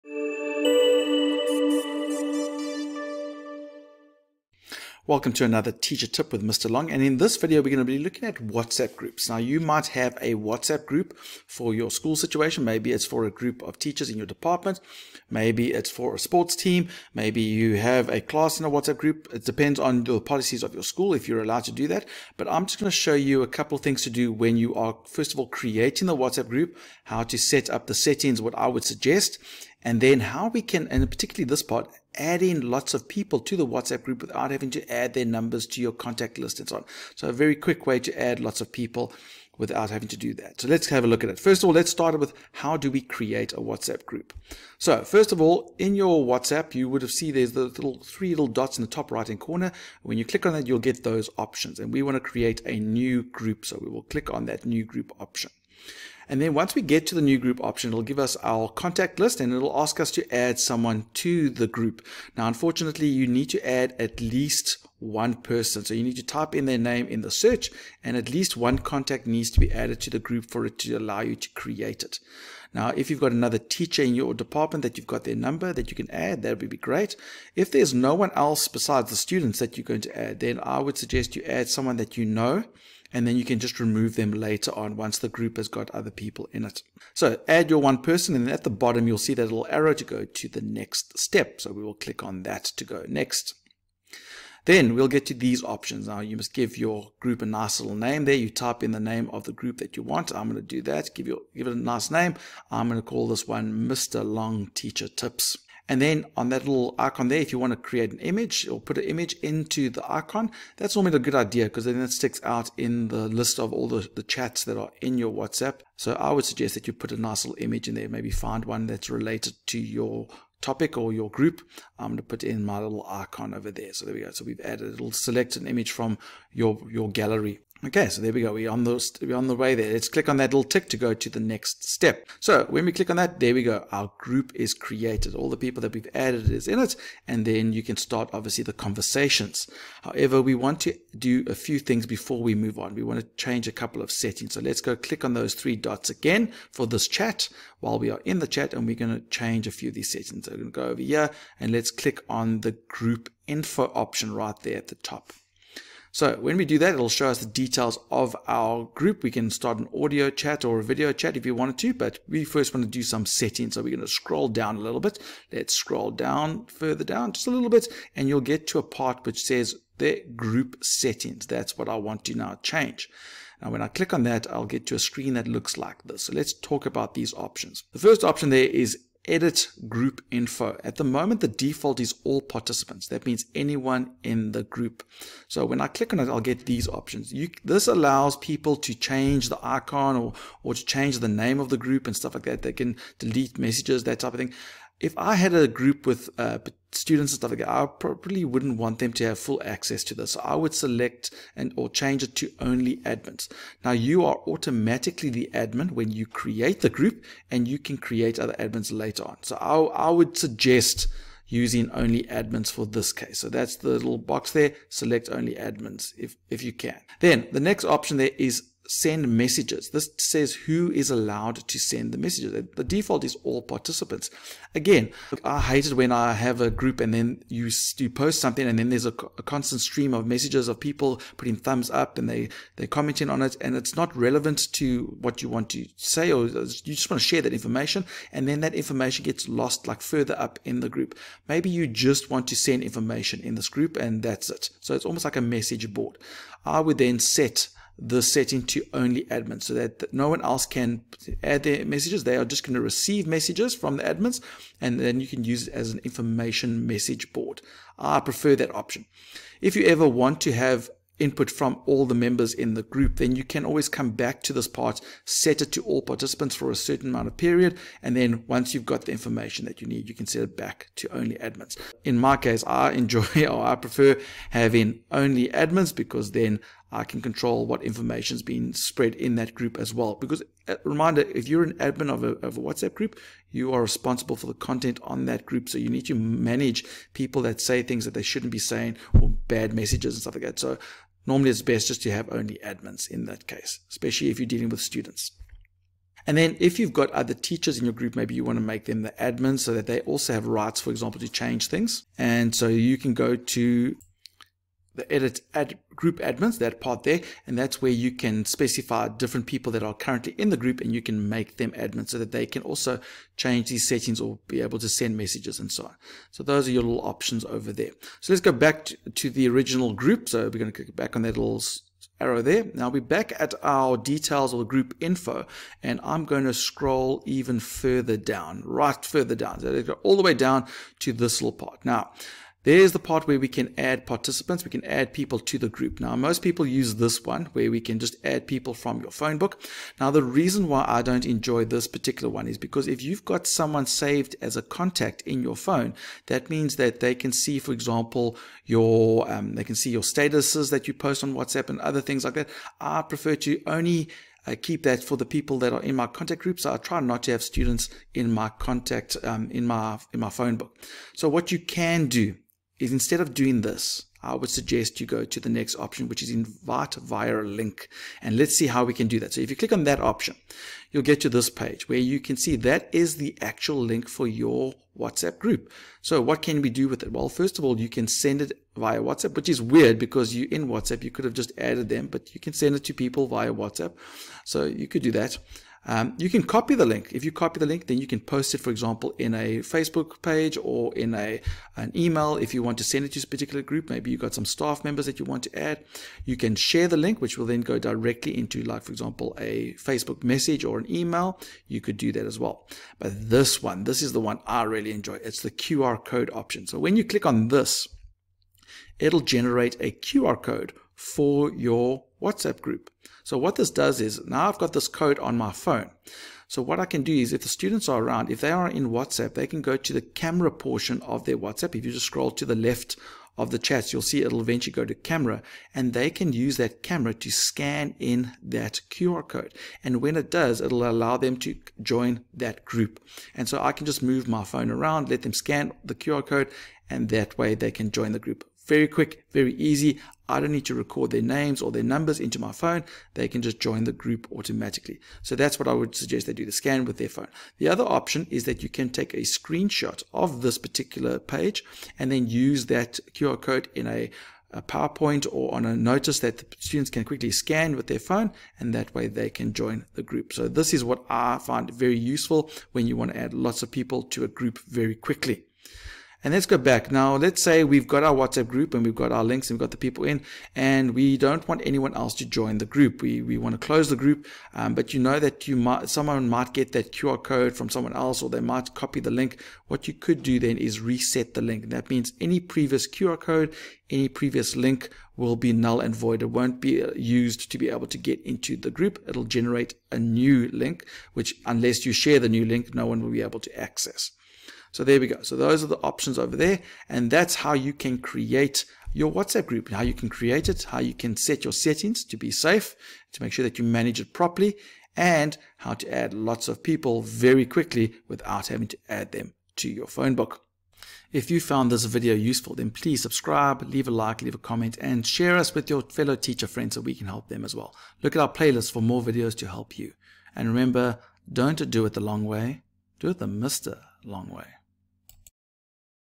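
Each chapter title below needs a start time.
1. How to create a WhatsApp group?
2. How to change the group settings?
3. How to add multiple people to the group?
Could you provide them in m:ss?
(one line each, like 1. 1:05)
1. 0:42
2. 2:20
3. 5:22.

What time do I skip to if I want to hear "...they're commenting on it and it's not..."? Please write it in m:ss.
3:52.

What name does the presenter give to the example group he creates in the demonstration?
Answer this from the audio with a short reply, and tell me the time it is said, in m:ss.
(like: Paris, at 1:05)
Mr. Long Teacher Tips, at 1:43.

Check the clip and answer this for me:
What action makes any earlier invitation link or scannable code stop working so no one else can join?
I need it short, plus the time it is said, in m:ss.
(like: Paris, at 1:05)
Reset the link, at 8:00.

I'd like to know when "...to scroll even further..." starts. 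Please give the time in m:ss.
5:26.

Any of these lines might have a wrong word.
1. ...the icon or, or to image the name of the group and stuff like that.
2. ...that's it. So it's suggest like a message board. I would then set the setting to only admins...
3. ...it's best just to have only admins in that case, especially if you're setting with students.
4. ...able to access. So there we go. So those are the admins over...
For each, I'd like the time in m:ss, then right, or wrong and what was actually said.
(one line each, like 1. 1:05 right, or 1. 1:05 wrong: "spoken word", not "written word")
1. 3:09 wrong: "change", not "image"
2. 4:04 wrong: "almost", not "suggest"
3. 4:51 wrong: "dealing", not "setting"
4. 8:13 wrong: "options", not "admins".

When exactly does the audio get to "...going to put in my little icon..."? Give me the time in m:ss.
2:02.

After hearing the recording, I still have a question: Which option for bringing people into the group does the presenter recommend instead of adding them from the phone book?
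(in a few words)
Invite via a link.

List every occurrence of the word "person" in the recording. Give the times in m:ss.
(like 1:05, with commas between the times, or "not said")
1:05, 1:27.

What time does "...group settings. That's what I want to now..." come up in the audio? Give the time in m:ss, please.
2:50.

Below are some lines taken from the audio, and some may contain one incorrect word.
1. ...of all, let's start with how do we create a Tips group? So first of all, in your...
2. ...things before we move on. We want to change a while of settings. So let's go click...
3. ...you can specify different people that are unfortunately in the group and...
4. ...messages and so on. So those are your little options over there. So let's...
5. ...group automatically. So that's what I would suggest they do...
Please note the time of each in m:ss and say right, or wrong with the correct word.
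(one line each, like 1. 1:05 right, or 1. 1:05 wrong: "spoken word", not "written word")
1. 0:41 wrong: "WhatsApp", not "Tips"
2. 2:21 wrong: "couple", not "while"
3. 5:07 wrong: "currently", not "unfortunately"
4. 5:15 right
5. 7:23 right.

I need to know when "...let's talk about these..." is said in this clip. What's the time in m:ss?
2:56.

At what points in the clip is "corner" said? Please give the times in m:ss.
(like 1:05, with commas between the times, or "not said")
0:49.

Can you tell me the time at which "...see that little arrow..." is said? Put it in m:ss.
1:29.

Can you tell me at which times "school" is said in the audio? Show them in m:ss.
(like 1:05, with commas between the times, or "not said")
0:11, 0:20.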